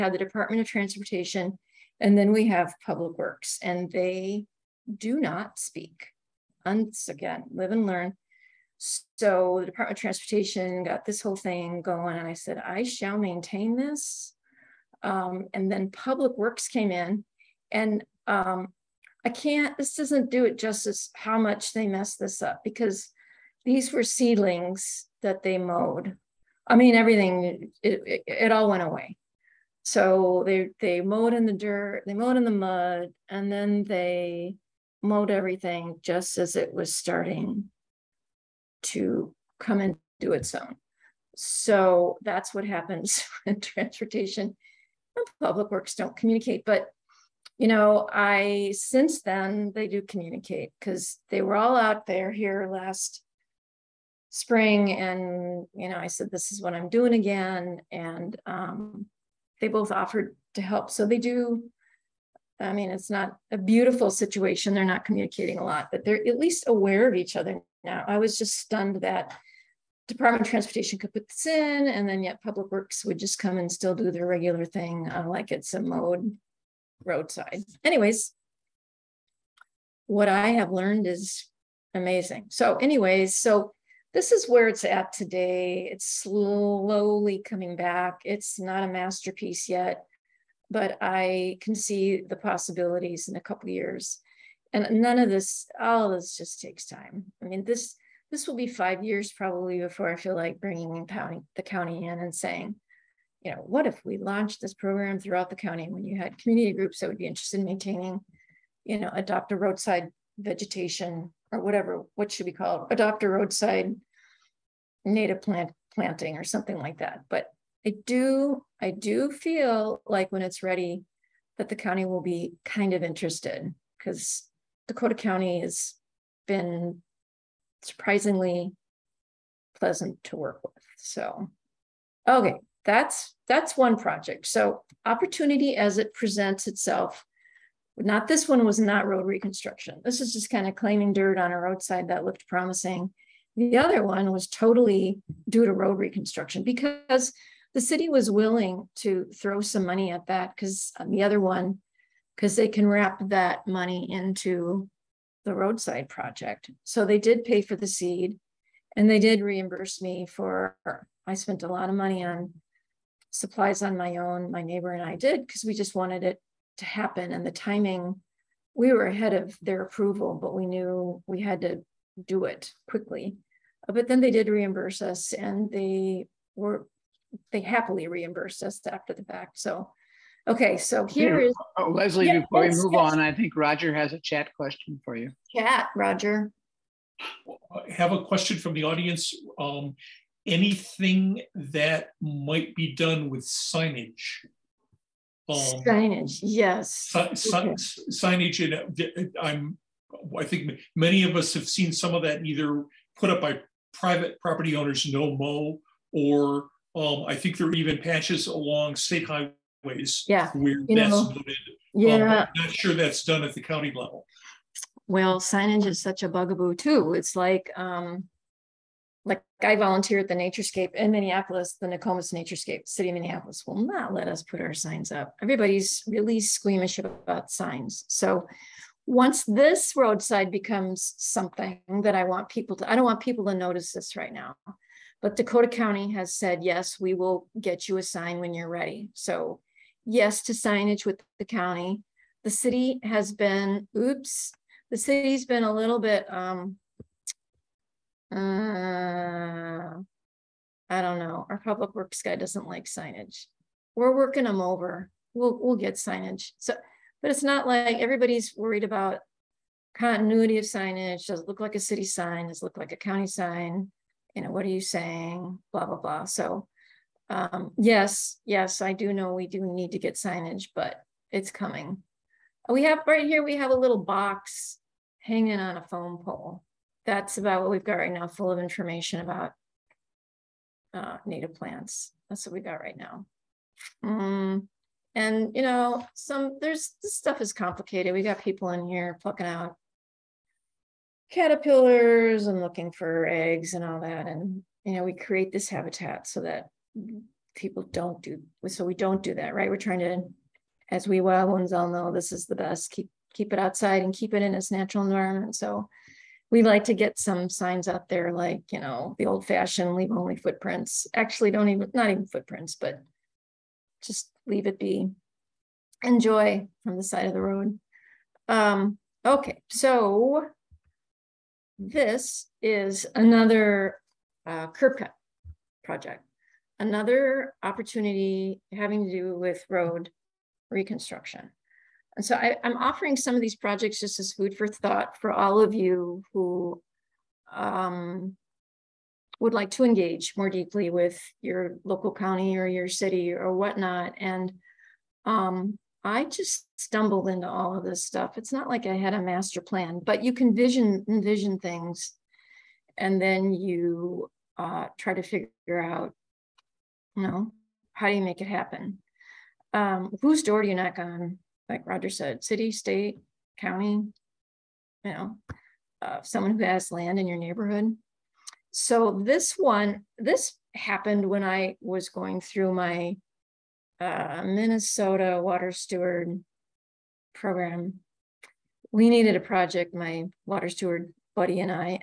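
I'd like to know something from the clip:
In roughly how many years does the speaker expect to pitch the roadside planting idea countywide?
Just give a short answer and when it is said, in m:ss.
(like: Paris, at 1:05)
5, at 1:38.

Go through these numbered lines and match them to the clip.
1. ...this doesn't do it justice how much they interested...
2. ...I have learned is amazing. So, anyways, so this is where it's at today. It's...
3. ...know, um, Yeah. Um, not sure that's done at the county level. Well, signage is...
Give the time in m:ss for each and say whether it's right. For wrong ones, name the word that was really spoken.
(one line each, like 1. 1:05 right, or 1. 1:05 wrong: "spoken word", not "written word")
1. 0:19 wrong: "messed", not "interested"
2. 1:20 right
3. 3:31 right.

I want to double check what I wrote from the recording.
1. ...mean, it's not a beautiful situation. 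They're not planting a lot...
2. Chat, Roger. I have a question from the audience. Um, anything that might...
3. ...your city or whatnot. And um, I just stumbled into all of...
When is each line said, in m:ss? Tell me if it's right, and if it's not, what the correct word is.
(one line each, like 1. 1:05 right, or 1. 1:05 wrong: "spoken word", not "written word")
1. 1:02 wrong: "communicating", not "planting"
2. 3:05 right
3. 5:42 right.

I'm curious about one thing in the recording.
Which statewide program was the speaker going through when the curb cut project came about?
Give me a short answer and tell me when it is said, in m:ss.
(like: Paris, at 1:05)
Minnesota Water Steward Program, at 6:14.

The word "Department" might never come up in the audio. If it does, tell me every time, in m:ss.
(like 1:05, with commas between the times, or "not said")
0:00, 0:09, 1:10.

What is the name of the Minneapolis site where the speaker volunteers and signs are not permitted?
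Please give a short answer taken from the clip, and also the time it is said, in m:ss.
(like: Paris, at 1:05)
Nokomis Naturescape, at 3:41.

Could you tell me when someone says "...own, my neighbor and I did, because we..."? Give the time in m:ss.
2:44.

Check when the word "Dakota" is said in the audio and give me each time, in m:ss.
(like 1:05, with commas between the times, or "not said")
2:04, 3:55.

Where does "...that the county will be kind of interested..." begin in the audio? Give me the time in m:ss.
2:01.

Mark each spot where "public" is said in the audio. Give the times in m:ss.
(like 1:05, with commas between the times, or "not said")
0:02, 0:15, 0:45, 1:12, 4:11.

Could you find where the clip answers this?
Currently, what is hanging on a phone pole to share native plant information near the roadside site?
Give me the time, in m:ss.
4:33.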